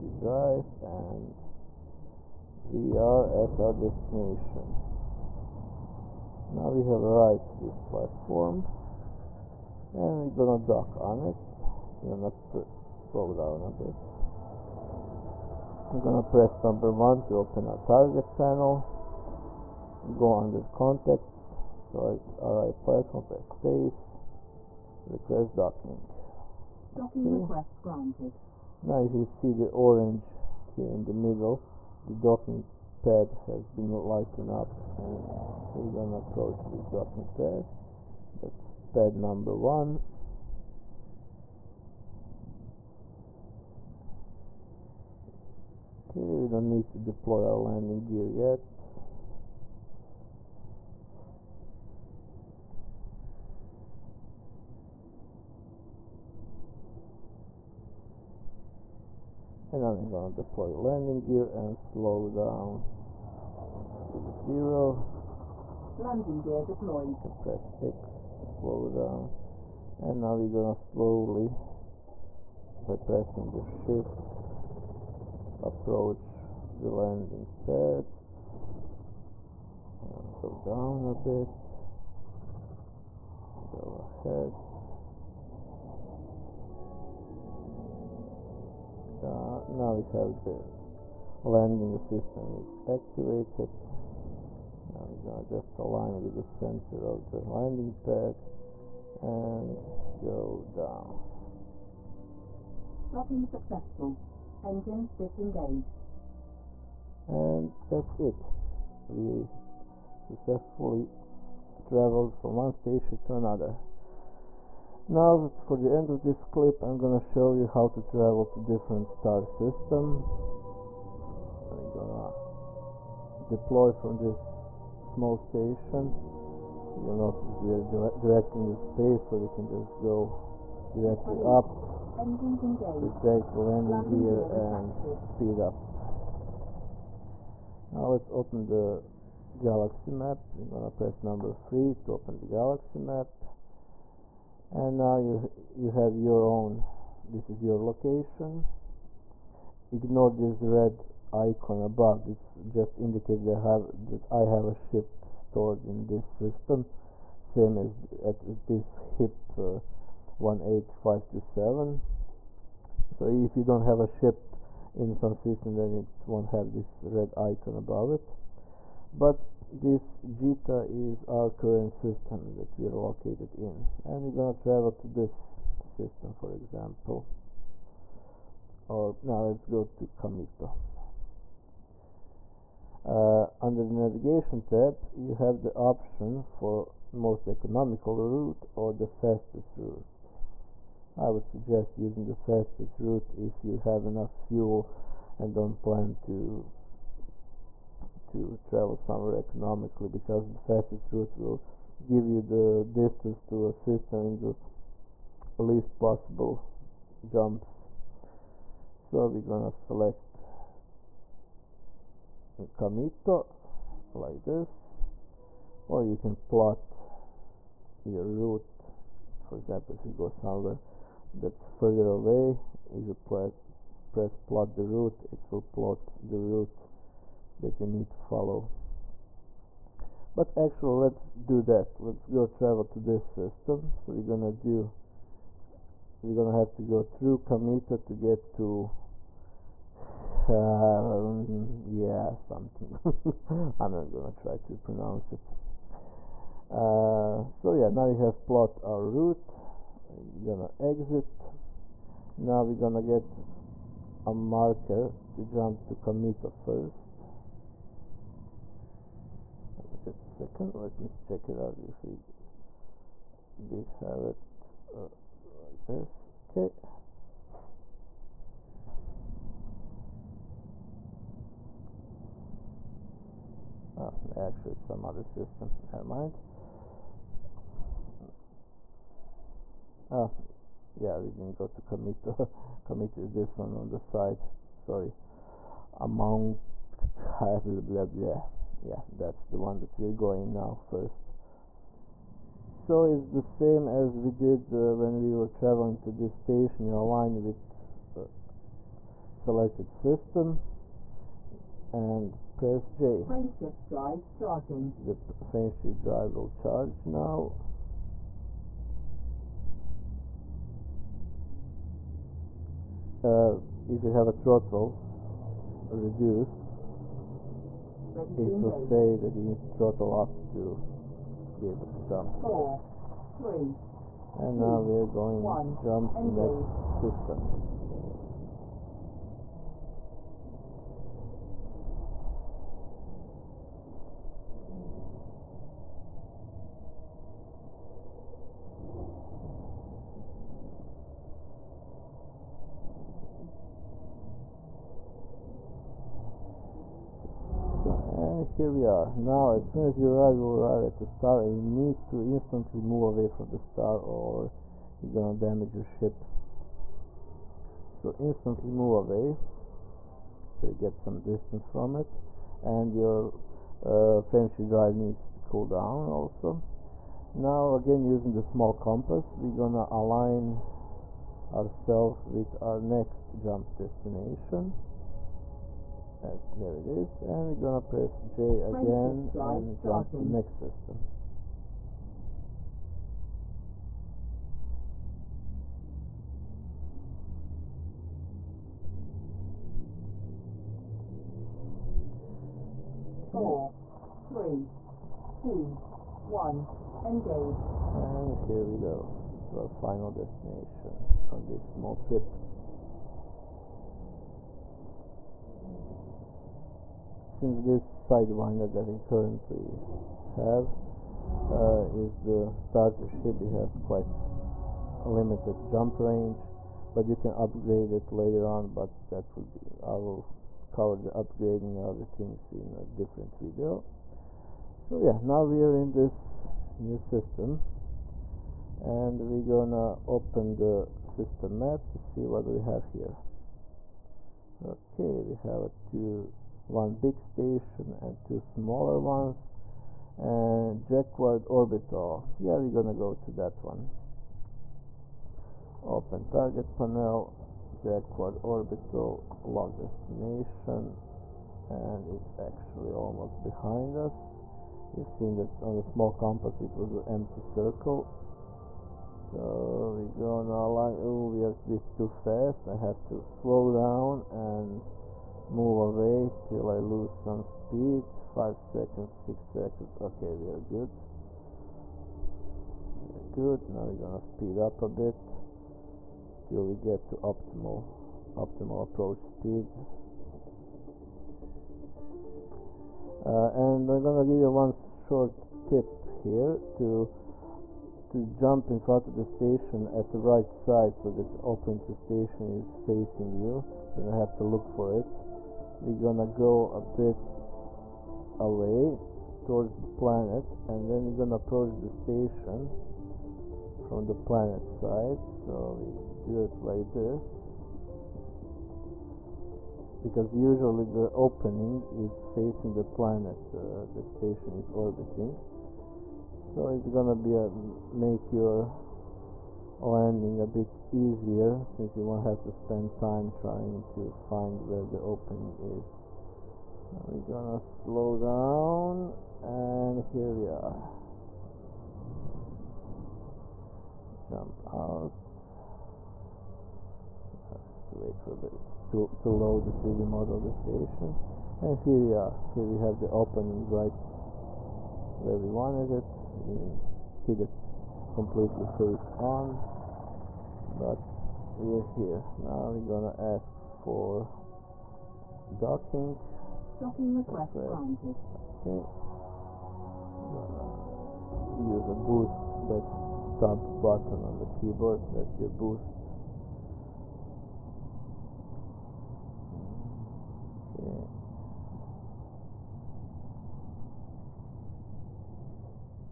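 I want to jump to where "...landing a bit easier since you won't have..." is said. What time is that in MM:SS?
08:39.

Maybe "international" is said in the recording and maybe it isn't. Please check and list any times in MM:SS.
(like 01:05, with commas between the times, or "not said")
not said.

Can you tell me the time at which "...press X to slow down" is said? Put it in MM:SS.
01:07.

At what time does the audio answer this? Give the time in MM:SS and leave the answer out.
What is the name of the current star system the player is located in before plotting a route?
02:50.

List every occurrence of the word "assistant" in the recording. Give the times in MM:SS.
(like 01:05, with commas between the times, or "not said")
01:31.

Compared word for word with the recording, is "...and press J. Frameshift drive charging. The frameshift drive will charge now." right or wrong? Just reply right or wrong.
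right.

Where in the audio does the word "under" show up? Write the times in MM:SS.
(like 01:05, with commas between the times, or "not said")
00:20, 03:03.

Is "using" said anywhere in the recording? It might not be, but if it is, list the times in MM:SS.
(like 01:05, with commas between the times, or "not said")
03:11, 06:08.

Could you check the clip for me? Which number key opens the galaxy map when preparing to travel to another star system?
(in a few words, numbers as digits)
3.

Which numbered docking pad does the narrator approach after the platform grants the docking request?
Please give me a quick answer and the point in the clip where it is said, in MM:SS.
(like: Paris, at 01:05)
1, at 00:38.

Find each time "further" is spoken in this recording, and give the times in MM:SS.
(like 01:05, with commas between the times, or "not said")
03:41.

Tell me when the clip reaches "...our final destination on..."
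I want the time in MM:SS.
06:39.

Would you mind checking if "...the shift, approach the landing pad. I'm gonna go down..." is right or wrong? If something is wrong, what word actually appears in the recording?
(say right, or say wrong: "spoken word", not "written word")
right.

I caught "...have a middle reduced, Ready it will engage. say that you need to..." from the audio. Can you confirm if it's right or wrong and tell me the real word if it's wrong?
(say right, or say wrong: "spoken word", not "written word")
wrong: "throttle", not "middle".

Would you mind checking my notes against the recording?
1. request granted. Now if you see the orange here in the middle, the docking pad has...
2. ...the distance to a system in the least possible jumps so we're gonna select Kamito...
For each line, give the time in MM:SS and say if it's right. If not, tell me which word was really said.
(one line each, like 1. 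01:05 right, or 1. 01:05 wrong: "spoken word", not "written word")
1. 00:27 right
2. 03:22 right.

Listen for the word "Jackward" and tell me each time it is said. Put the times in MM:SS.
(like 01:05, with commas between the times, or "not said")
07:20, 07:27.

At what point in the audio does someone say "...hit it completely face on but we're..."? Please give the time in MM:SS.
09:07.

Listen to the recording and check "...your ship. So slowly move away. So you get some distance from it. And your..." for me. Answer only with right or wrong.
wrong.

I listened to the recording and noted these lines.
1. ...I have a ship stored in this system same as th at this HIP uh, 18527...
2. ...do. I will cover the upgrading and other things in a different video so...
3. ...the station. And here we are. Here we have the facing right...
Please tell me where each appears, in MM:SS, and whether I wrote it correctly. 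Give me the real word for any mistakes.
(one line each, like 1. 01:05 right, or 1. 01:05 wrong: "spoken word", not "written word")
1. 02:34 right
2. 06:59 right
3. 09:00 wrong: "opening", not "facing".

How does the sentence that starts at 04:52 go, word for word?
So it's the same as we did uh, when we were traveling to this station.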